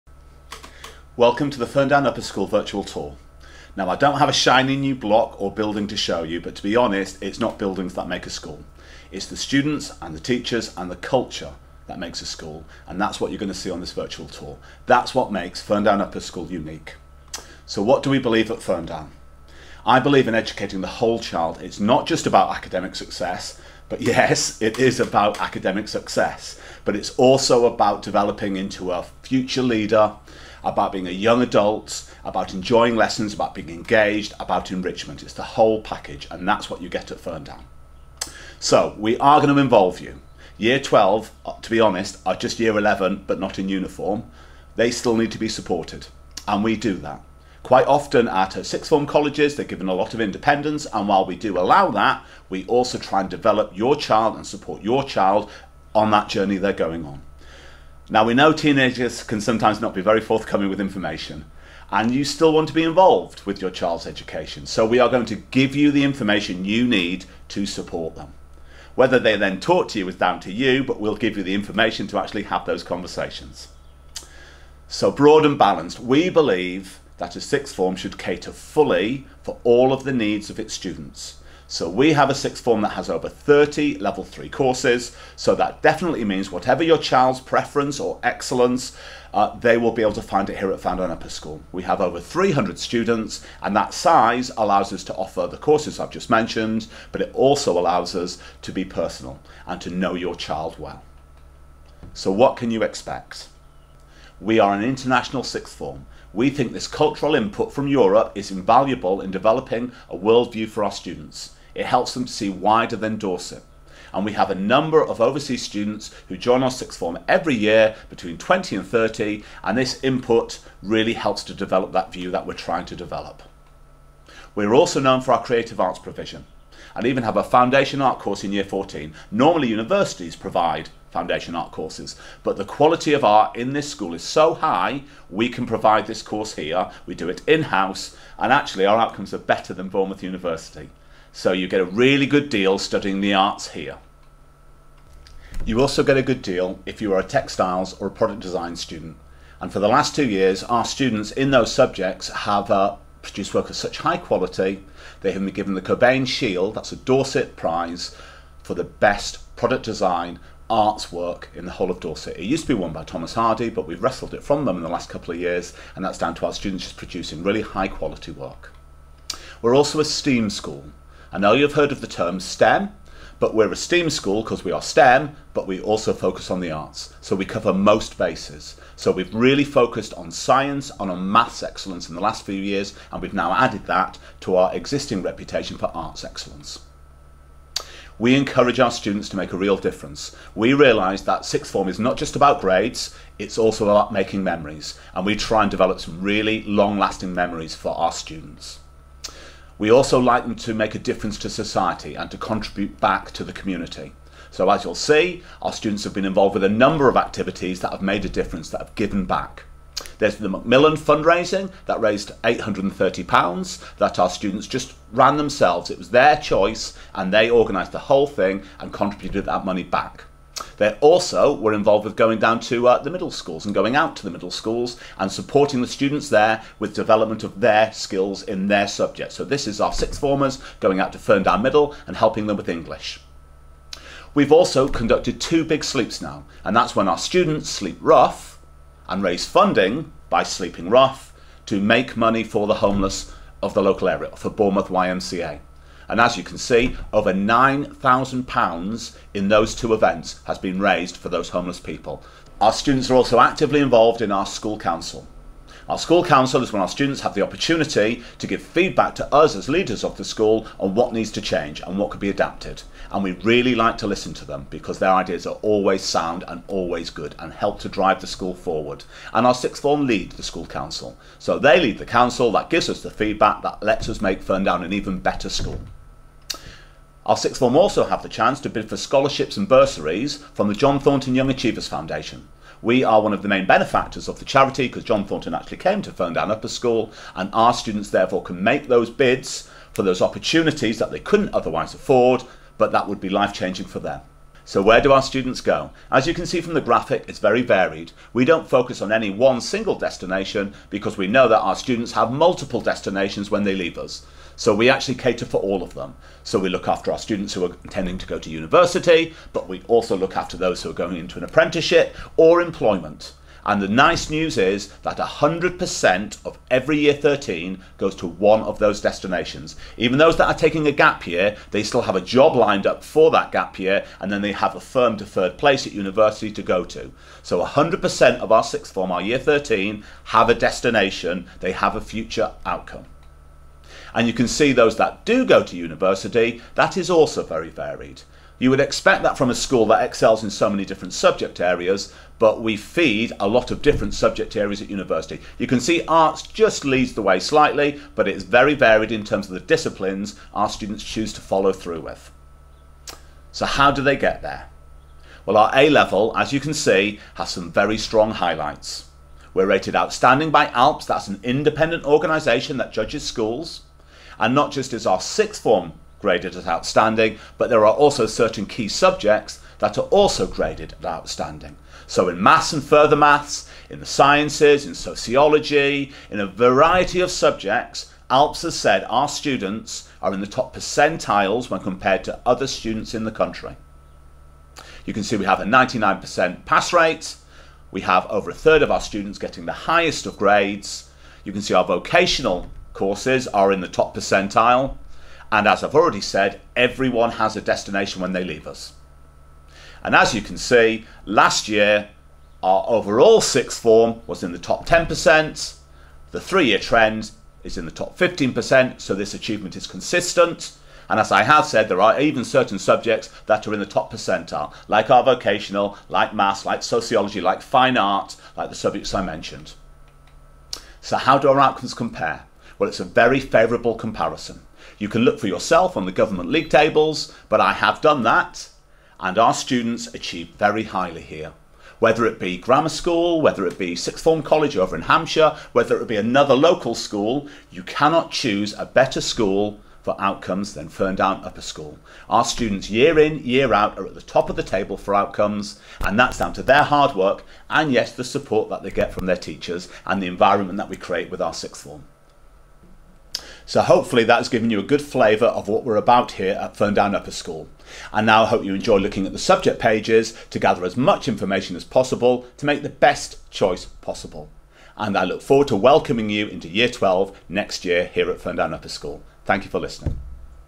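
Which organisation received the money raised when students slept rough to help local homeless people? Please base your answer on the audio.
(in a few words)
Bournemouth YMCA.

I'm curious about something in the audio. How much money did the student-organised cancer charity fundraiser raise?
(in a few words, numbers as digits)
£830.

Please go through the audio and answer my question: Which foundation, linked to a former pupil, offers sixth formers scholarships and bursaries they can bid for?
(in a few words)
John Thornton Young Achievers Foundation.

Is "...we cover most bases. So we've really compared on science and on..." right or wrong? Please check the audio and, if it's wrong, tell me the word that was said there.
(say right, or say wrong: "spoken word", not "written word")
wrong: "focused", not "compared".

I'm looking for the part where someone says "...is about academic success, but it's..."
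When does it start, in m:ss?
0:24.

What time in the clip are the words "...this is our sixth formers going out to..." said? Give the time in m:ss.
3:49.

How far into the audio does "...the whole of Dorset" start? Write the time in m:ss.
2:41.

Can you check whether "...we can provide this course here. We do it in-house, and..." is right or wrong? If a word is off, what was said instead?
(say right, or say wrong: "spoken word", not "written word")
right.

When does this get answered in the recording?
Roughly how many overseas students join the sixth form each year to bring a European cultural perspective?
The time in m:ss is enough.
1:58.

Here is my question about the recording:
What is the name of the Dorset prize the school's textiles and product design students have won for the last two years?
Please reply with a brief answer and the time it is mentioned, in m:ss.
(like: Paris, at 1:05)
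Cobain Shield, at 2:35.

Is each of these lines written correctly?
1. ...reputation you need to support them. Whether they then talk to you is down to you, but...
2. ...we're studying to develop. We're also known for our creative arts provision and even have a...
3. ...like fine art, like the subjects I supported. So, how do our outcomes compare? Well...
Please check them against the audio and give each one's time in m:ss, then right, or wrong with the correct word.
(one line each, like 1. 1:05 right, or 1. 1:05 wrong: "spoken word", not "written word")
1. 1:06 wrong: "information", not "reputation"
2. 2:02 wrong: "trying", not "studying"
3. 6:57 wrong: "mentioned", not "supported".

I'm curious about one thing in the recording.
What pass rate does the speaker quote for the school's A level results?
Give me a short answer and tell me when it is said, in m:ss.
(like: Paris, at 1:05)
99%, at 6:25.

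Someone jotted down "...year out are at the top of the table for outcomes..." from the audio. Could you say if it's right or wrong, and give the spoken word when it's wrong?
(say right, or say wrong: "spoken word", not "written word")
right.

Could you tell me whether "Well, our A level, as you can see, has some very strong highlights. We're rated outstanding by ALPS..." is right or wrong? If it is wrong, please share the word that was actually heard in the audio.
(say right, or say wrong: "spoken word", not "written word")
right.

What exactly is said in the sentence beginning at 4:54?
So, where do our students go?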